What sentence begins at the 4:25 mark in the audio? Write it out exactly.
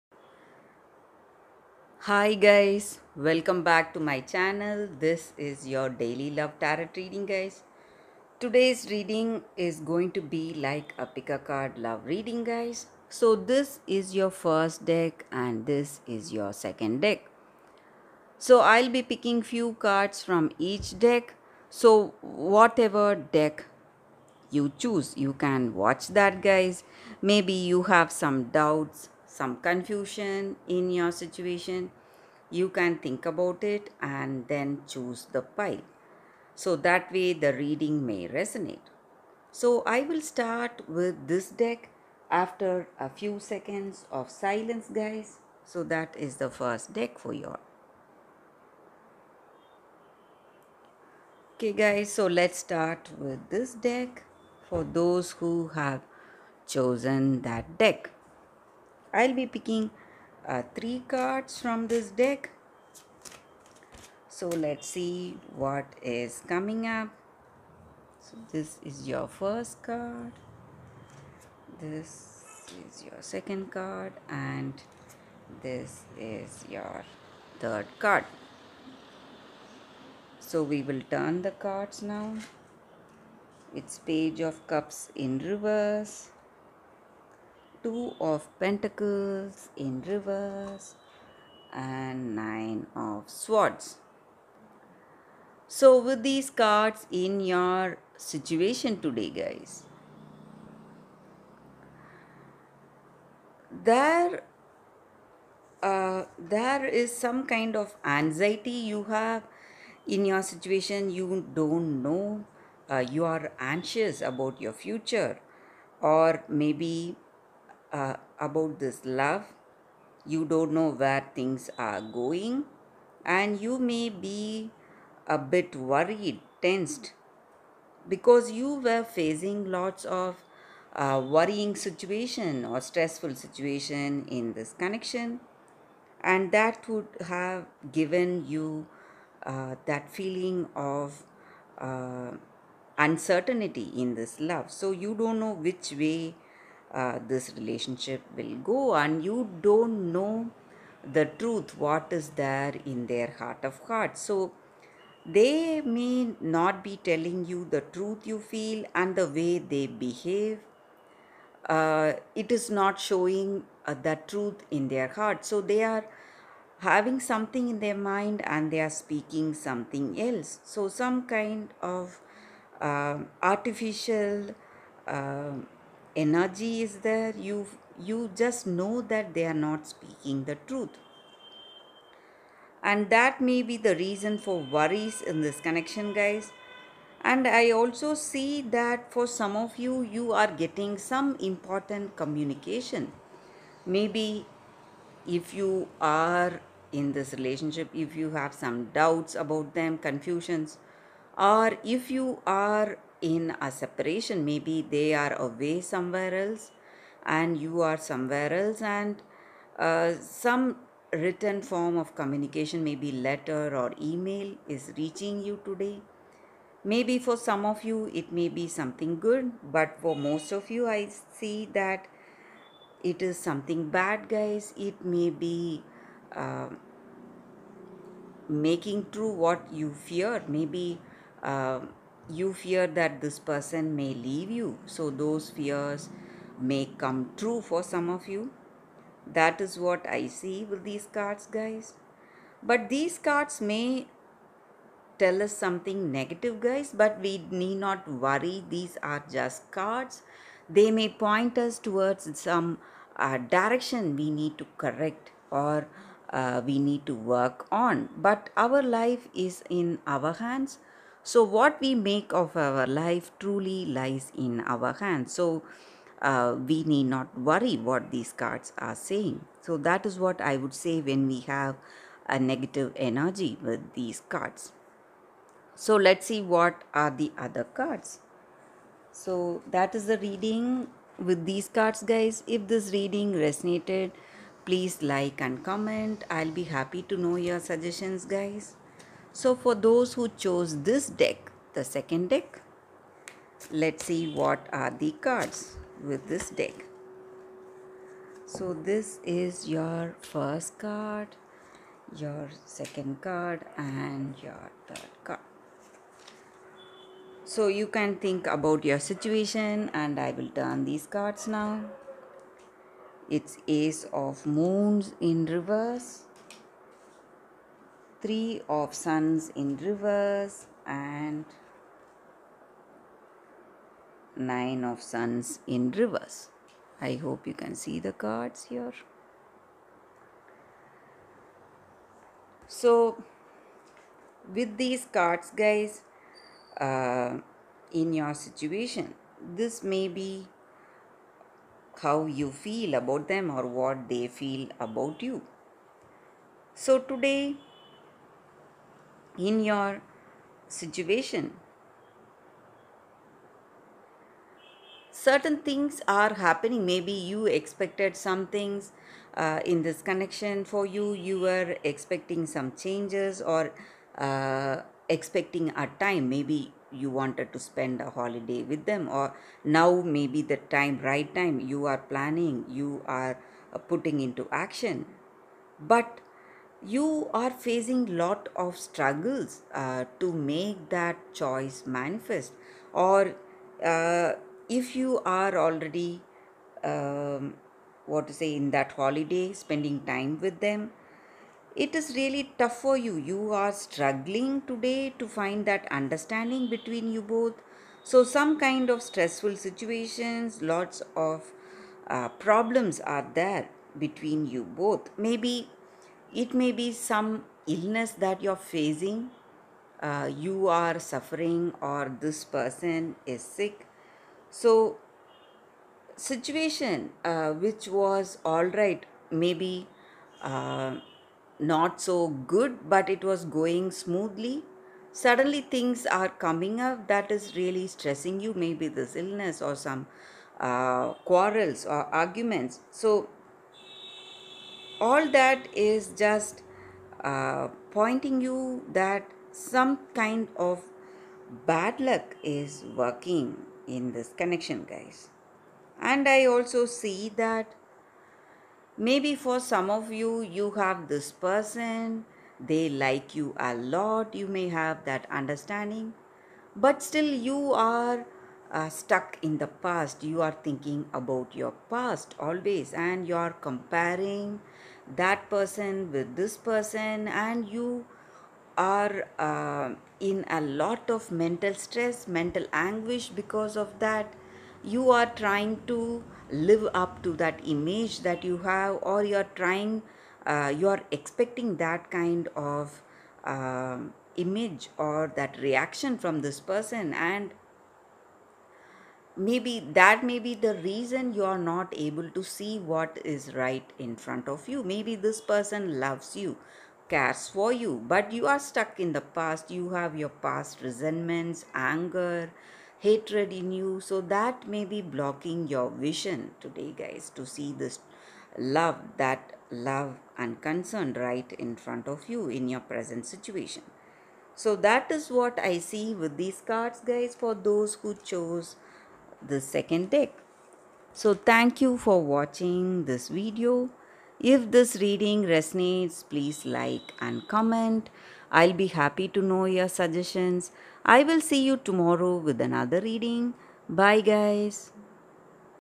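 So, uh, we need not worry what these cards are saying.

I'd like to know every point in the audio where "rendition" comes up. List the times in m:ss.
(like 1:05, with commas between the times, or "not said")
not said.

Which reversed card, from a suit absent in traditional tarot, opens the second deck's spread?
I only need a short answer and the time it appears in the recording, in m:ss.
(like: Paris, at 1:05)
Ace of Moons, at 5:13.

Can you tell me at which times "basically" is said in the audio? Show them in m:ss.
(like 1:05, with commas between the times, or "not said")
not said.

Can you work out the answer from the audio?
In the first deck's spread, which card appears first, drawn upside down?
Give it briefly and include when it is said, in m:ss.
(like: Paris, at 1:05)
Page of Cups, at 1:23.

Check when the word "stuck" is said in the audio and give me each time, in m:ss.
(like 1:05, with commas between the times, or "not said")
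7:38, 8:18.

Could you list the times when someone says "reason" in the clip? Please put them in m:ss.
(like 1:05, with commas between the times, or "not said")
3:03, 8:10.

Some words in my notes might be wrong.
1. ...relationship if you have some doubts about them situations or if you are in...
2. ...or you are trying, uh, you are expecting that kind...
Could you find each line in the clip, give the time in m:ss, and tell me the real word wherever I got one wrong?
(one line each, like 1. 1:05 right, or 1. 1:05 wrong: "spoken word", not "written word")
1. 3:17 wrong: "confusions", not "situations"
2. 7:59 right.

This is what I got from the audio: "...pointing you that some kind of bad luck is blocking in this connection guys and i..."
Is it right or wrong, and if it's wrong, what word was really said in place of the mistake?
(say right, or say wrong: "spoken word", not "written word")
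wrong: "working", not "blocking".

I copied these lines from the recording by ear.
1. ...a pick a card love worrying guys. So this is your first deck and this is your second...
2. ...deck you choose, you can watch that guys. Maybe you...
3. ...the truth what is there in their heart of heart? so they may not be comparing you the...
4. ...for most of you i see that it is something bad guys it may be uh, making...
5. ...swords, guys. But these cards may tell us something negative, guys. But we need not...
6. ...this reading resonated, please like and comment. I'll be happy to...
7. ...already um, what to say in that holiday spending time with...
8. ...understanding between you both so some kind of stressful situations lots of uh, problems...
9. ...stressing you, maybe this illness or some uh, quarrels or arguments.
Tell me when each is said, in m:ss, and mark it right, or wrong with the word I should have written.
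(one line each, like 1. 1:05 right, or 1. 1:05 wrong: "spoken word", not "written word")
1. 0:10 wrong: "reading", not "worrying"
2. 0:23 right
3. 2:31 wrong: "telling", not "comparing"
4. 3:39 right
5. 4:01 wrong: "cards", not "swords"
6. 4:42 right
7. 6:25 right
8. 6:35 right
9. 7:07 right.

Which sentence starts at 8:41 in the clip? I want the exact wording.
So thank you for watching this video.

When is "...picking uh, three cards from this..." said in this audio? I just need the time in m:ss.
0:59.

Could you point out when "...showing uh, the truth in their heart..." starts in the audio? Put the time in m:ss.
2:42.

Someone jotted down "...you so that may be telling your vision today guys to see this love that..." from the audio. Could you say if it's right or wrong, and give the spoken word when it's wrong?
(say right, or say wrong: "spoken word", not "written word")
wrong: "blocking", not "telling".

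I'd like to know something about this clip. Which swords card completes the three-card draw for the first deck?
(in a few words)
Nine of Swords.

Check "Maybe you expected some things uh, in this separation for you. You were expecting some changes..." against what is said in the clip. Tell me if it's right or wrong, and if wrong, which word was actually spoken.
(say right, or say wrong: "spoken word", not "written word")
wrong: "connection", not "separation".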